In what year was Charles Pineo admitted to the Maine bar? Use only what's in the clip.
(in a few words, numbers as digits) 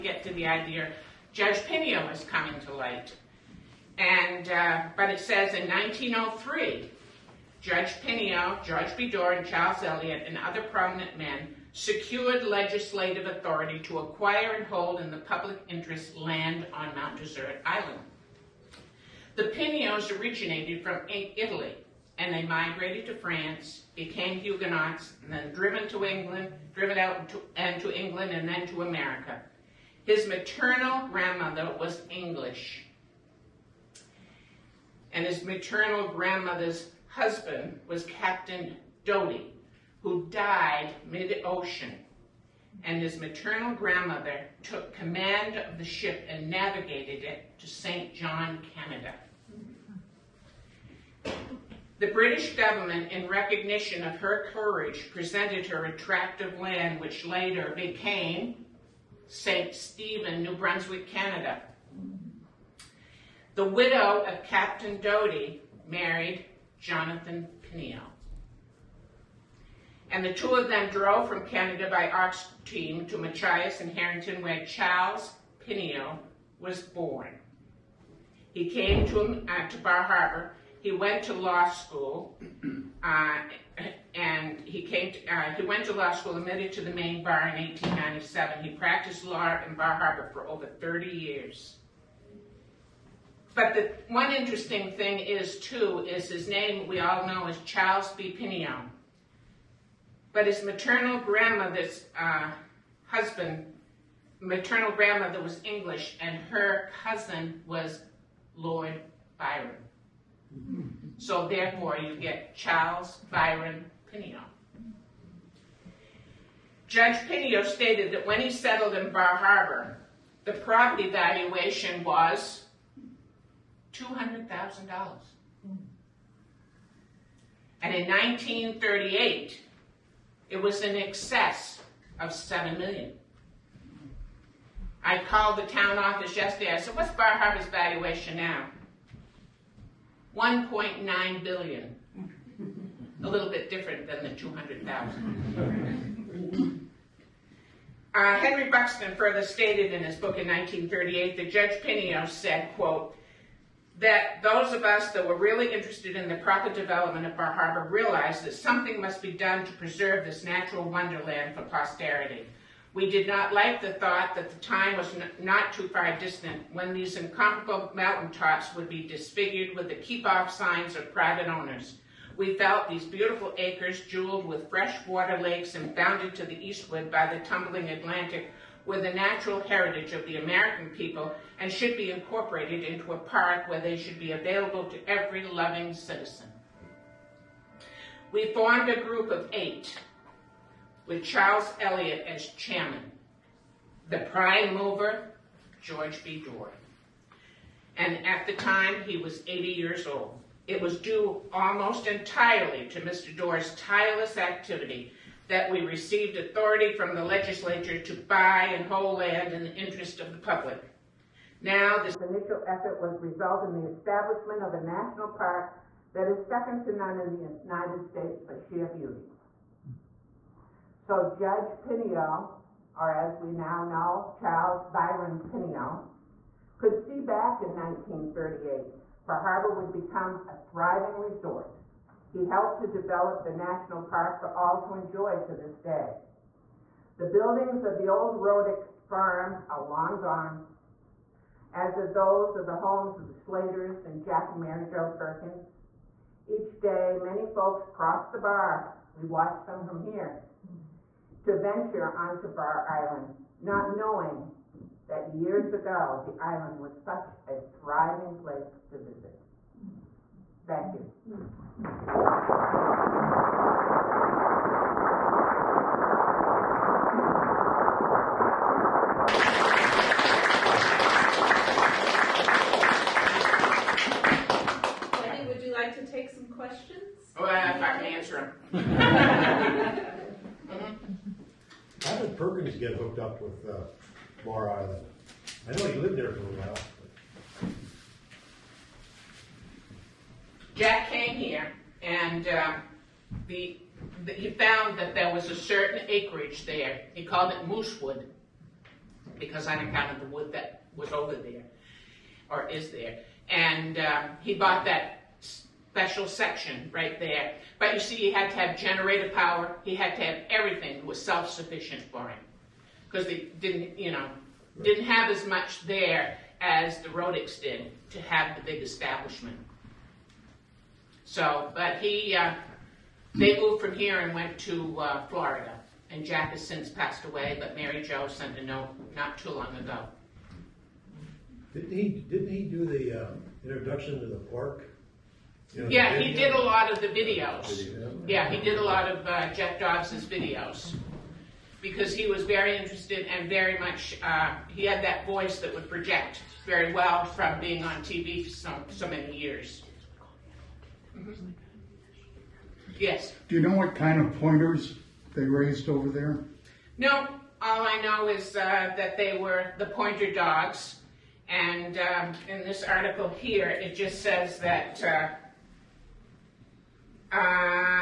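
1897.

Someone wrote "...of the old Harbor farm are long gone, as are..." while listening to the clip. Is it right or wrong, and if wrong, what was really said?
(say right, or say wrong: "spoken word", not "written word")
wrong: "Rodick", not "Harbor".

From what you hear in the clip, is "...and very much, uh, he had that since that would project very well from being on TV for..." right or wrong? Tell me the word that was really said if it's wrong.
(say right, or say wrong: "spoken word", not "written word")
wrong: "voice", not "since".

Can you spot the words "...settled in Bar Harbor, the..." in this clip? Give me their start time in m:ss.
1:58.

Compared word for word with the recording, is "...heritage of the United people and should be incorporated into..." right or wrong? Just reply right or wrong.
wrong.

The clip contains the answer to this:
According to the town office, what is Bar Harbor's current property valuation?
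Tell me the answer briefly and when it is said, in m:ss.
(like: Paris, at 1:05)
1.9 billion, at 2:20.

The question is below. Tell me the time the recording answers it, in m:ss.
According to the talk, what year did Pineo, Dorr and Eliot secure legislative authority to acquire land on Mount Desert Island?
0:05.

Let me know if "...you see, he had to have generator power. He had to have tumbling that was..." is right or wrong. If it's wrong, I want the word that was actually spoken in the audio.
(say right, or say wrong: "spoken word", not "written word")
wrong: "everything", not "tumbling".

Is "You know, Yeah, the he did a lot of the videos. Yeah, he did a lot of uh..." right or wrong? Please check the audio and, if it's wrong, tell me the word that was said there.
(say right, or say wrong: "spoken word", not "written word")
right.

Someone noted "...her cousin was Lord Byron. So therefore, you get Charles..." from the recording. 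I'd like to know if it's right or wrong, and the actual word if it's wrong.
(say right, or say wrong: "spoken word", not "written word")
right.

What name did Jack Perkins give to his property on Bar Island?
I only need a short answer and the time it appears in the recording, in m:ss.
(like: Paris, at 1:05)
Moosewood, at 4:57.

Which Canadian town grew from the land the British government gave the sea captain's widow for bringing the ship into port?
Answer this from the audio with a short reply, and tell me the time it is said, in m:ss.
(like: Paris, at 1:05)
St. Stephen, at 0:59.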